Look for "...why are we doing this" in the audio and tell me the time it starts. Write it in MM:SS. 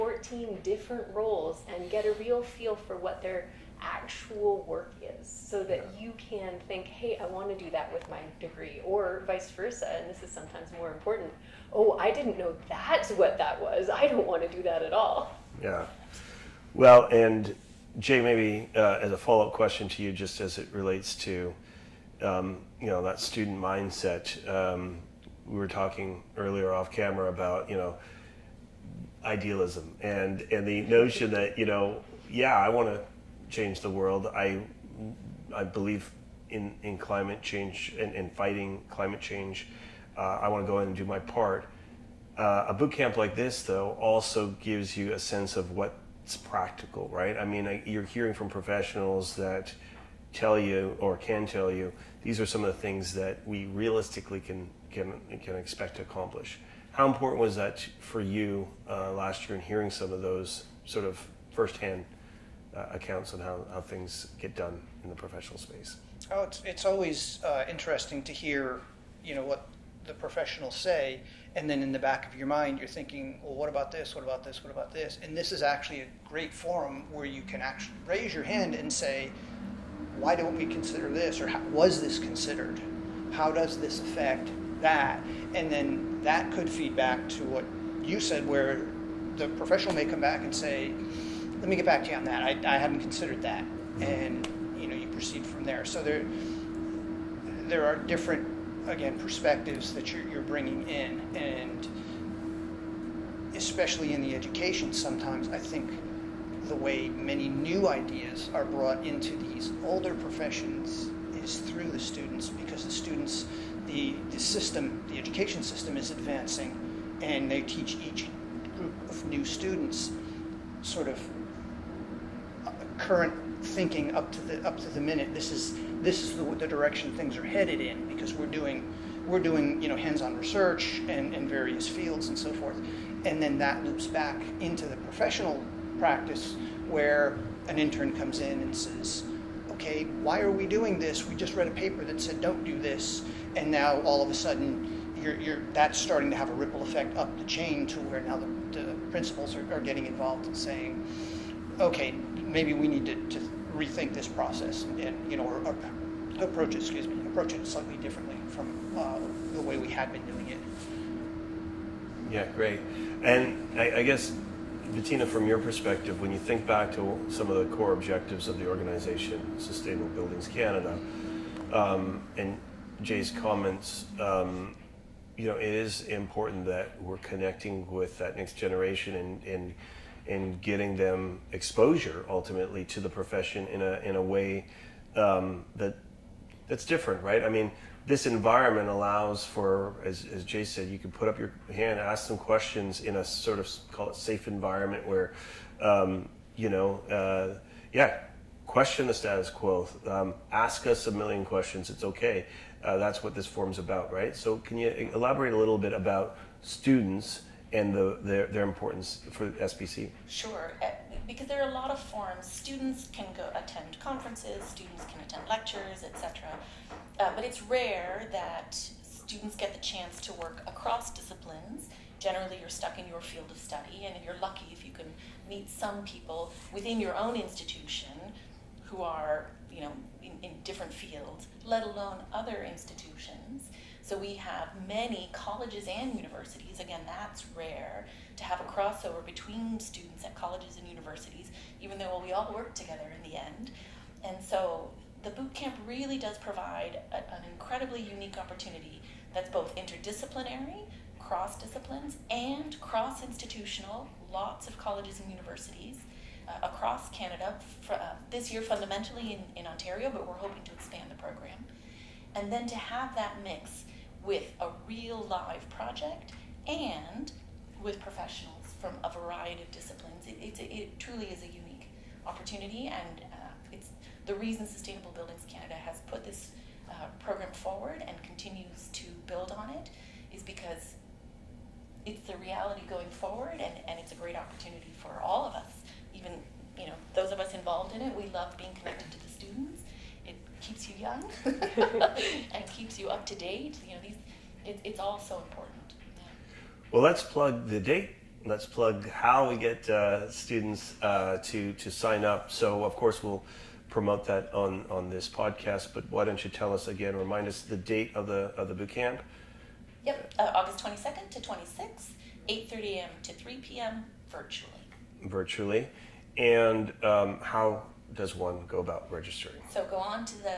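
02:20.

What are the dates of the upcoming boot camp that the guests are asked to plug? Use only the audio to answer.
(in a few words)
August 22 to 26.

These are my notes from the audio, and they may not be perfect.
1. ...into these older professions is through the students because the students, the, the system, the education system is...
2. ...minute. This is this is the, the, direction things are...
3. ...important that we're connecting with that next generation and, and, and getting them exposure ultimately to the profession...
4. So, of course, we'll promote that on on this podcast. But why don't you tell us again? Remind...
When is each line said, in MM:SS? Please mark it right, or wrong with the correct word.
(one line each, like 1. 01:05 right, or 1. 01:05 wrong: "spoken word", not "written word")
1. 01:49 right
2. 02:04 right
3. 02:56 right
4. 05:02 right.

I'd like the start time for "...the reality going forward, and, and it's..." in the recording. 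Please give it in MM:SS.
04:42.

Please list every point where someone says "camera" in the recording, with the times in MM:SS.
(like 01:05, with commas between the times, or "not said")
00:26.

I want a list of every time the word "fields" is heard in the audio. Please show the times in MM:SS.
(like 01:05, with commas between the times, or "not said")
02:11, 03:43, 03:50.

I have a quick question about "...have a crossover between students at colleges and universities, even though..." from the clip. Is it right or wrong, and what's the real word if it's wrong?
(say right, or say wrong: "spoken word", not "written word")
right.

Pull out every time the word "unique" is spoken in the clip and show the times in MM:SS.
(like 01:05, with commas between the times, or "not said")
04:08, 04:31.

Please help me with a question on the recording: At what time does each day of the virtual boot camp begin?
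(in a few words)
8:30 a.m.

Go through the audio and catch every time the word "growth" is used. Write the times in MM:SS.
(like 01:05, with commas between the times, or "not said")
not said.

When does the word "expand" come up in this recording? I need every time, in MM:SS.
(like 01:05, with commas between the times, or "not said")
04:20.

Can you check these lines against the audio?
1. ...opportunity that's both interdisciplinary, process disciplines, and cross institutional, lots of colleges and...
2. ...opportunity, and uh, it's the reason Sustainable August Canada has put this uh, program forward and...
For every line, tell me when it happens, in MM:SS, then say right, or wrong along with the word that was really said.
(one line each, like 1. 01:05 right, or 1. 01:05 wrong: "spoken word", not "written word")
1. 04:08 wrong: "cross", not "process"
2. 04:32 wrong: "Buildings", not "August".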